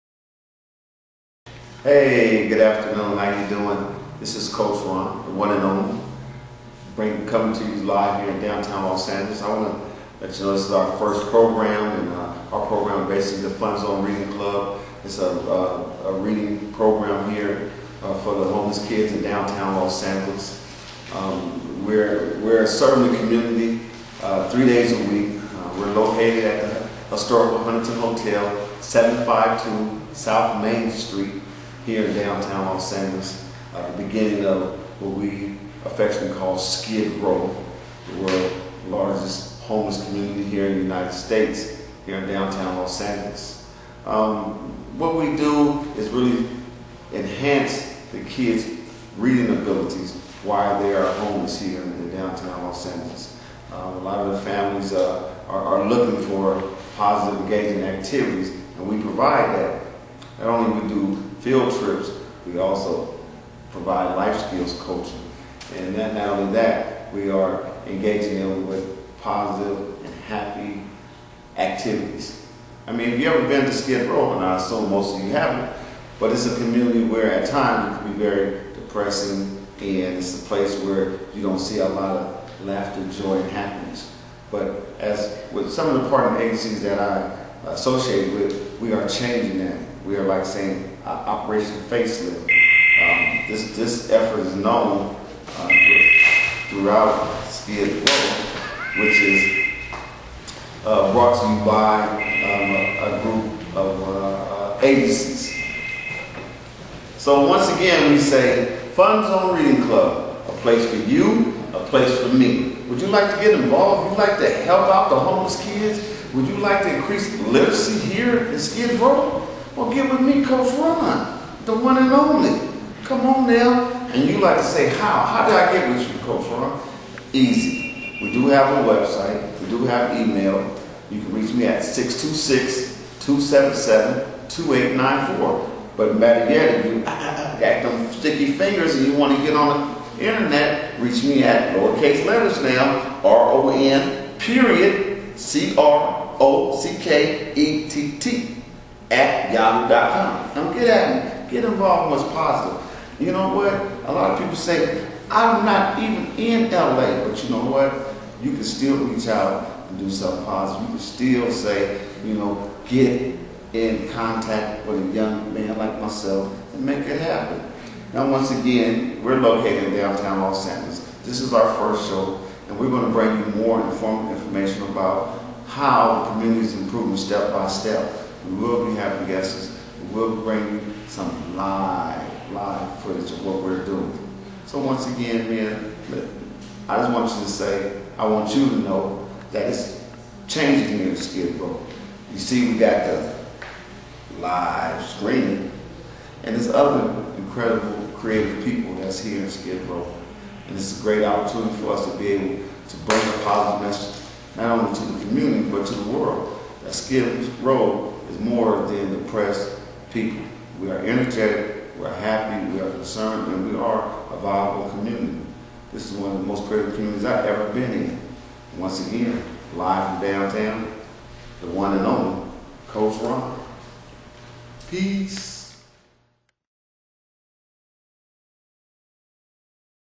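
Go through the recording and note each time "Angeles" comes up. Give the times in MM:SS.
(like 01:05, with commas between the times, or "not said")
00:09, 00:20, 00:32, 00:43, 00:52, 02:50.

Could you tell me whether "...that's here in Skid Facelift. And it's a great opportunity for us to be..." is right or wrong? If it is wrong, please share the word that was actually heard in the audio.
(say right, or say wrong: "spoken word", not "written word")
wrong: "Row", not "Facelift".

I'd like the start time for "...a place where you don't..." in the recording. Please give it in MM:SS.
01:20.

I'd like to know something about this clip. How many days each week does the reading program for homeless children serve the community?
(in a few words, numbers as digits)
3.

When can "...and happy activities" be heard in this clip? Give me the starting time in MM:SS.
01:10.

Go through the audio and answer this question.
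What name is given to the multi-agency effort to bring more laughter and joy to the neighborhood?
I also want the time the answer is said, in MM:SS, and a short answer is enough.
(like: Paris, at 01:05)
Operation Facelift, at 01:31.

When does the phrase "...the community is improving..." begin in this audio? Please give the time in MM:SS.
02:56.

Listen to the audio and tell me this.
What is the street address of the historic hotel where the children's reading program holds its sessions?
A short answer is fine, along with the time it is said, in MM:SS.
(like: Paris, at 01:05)
752 South Main Street, at 00:28.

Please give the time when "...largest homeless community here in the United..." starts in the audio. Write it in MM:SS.
00:38.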